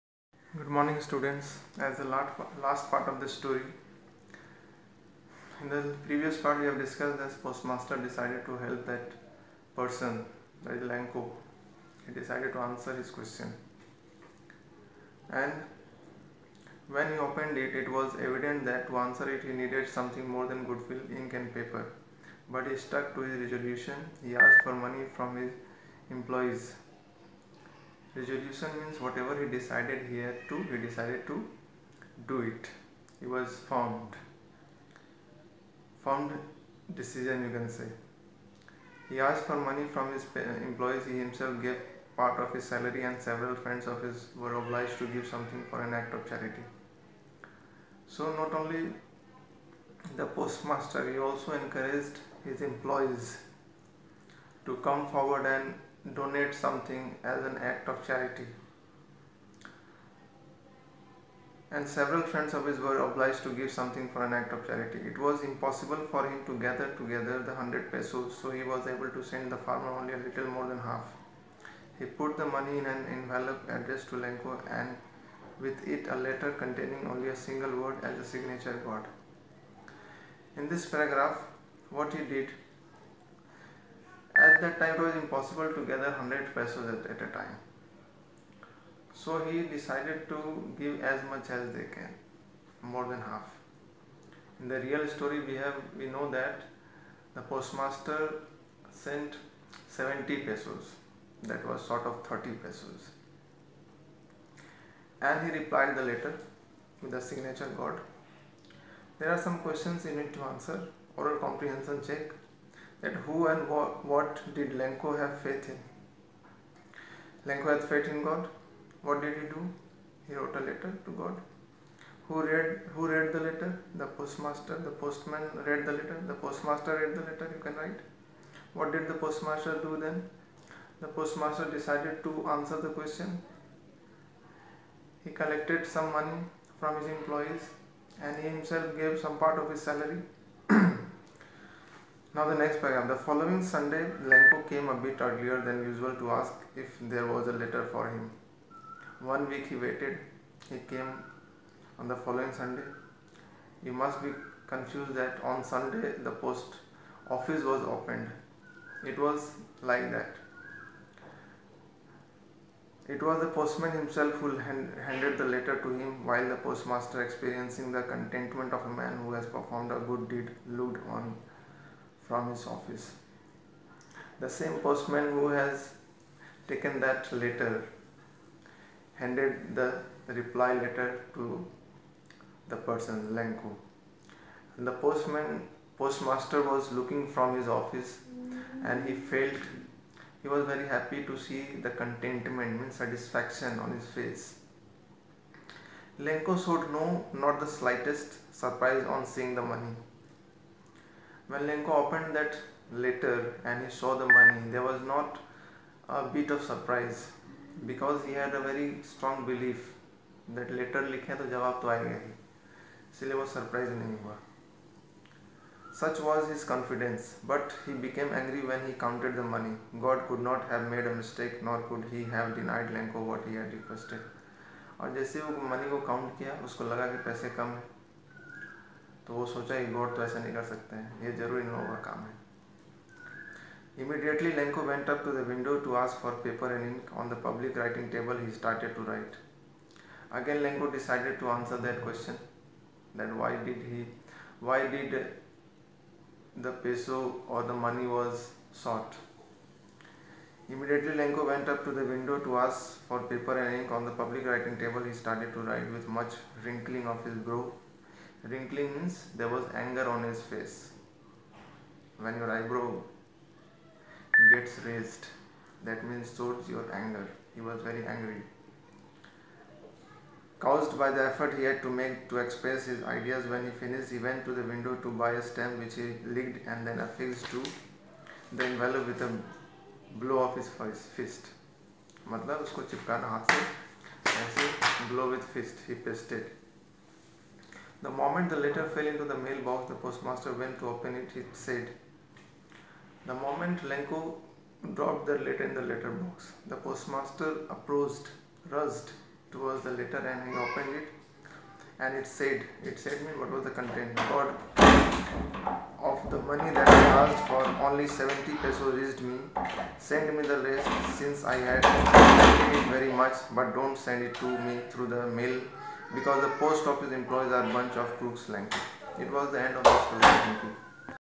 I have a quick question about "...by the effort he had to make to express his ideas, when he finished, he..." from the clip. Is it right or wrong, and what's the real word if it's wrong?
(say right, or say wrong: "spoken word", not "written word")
right.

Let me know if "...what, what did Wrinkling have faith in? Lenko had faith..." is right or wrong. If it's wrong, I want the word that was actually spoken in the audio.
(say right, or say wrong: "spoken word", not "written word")
wrong: "Lenko", not "Wrinkling".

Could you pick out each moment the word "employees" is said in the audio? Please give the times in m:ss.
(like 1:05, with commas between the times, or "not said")
0:26, 0:40, 0:52, 2:17, 5:17.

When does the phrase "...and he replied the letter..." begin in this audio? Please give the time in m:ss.
1:45.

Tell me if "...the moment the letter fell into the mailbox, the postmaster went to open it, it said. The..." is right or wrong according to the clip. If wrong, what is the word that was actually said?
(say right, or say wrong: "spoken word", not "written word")
right.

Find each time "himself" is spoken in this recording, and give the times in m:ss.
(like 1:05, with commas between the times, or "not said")
0:41, 2:18, 2:43.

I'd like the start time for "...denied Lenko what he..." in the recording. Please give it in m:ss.
3:42.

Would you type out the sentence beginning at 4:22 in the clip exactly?
When your eyebrow gets raised, that means shows your anger.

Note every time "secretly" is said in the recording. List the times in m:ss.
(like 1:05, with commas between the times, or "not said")
not said.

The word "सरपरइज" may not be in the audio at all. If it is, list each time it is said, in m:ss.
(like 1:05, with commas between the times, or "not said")
3:33.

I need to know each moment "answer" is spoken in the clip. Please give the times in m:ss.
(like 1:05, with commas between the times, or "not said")
0:12, 0:18, 1:50, 2:12.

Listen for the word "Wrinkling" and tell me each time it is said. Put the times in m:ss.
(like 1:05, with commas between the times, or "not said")
4:18.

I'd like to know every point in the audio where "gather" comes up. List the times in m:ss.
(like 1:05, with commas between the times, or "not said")
1:06, 1:25.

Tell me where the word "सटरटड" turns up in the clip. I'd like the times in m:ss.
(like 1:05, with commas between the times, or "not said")
3:58, 4:15.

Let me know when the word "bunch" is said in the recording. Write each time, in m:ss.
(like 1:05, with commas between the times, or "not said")
5:17.